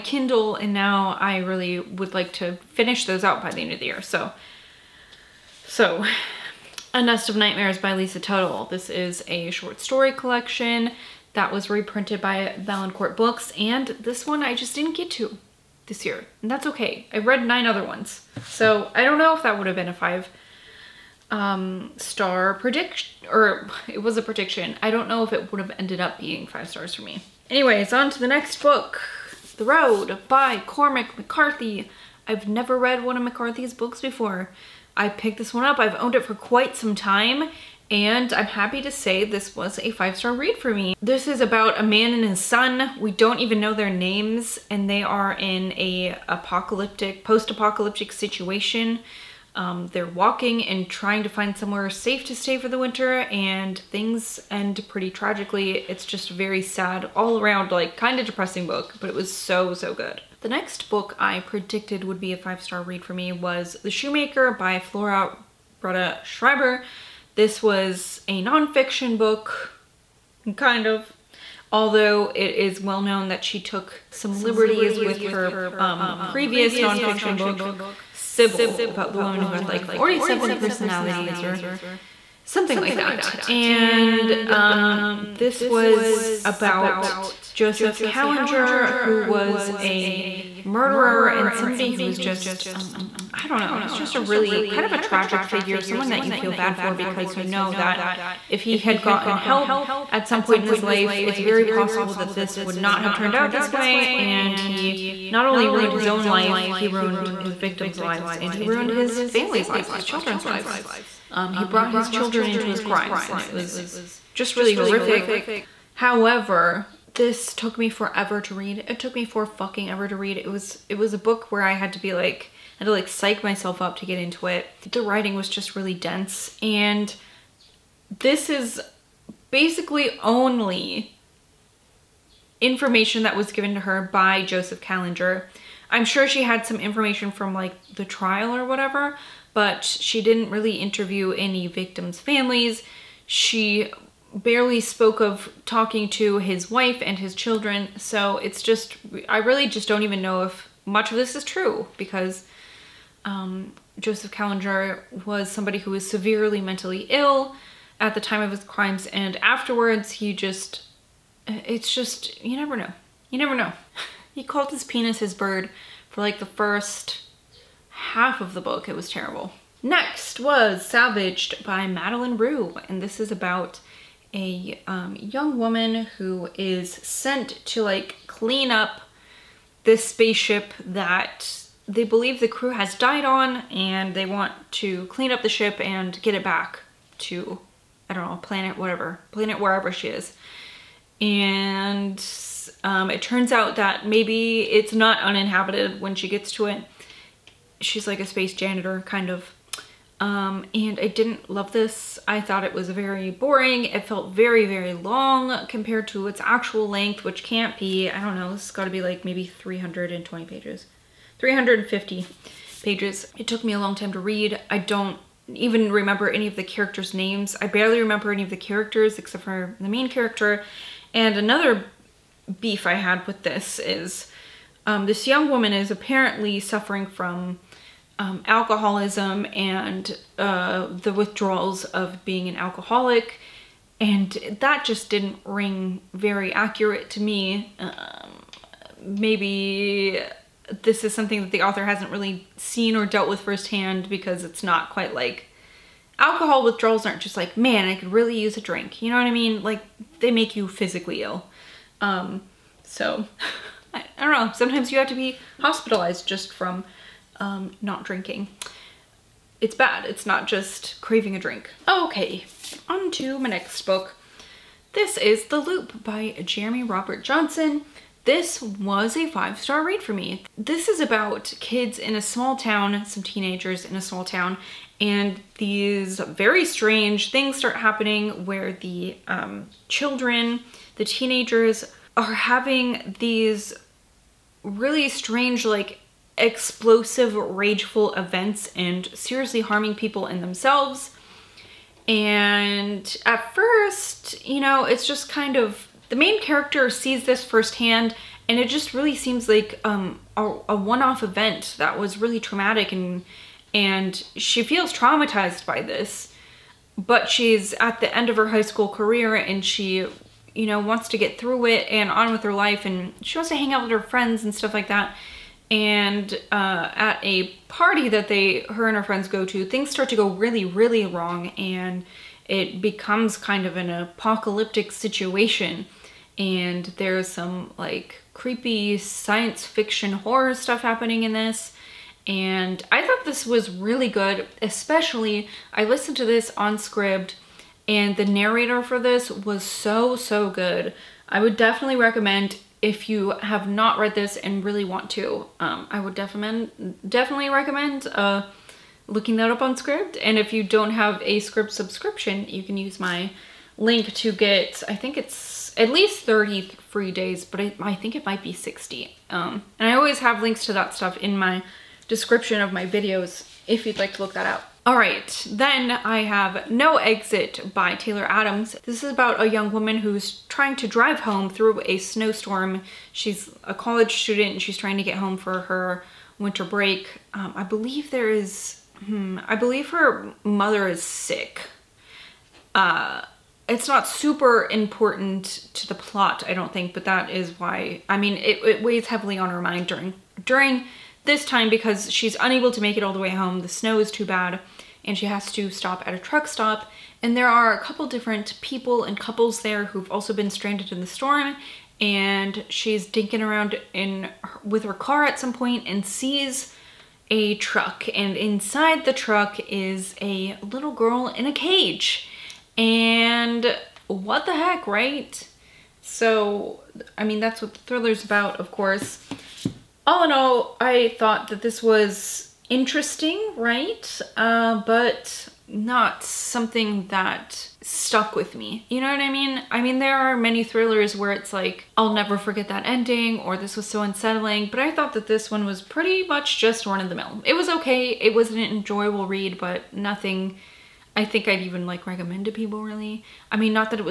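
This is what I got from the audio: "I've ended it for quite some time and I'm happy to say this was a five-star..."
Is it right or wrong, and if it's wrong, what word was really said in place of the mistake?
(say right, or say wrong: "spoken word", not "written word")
wrong: "owned", not "ended".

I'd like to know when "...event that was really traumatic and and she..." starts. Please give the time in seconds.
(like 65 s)
301 s.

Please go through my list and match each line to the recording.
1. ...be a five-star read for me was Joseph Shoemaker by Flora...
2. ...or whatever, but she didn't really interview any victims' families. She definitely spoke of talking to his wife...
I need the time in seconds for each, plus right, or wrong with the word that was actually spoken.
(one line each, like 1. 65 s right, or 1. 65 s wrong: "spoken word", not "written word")
1. 62 s wrong: "The", not "Joseph"
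2. 138 s wrong: "barely", not "definitely".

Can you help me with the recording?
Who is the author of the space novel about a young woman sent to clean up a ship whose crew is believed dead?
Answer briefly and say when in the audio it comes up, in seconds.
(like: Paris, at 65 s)
Madeleine Roux, at 171 s.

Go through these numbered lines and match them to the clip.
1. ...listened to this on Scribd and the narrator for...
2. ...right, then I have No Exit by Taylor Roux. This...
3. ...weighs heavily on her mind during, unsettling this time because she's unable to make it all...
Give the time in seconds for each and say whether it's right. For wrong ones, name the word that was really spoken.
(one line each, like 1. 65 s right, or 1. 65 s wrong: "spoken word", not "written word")
1. 335 s right
2. 364 s wrong: "Adams", not "Roux"
3. 388 s wrong: "during", not "unsettling".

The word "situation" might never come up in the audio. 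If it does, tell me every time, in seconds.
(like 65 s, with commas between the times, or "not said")
48 s, 324 s.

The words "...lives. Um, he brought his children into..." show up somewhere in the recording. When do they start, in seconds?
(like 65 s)
110 s.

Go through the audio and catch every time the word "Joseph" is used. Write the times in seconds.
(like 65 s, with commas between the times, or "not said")
87 s, 134 s, 153 s.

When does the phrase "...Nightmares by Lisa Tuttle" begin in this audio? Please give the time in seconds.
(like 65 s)
7 s.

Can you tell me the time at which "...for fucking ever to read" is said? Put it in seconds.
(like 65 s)
119 s.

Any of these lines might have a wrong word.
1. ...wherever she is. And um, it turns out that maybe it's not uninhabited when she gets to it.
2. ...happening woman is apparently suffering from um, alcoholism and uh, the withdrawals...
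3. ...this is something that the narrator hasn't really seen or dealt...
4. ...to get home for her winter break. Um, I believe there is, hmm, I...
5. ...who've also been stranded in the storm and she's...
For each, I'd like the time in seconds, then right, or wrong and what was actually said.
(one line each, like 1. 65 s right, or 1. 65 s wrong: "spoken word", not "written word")
1. 189 s right
2. 225 s wrong: "young", not "happening"
3. 240 s wrong: "author", not "narrator"
4. 374 s right
5. 399 s right.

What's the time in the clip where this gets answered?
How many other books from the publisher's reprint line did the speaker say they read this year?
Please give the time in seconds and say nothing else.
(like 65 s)
17 s.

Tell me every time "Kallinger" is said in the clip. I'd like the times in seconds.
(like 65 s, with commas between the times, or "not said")
88 s, 134 s, 154 s.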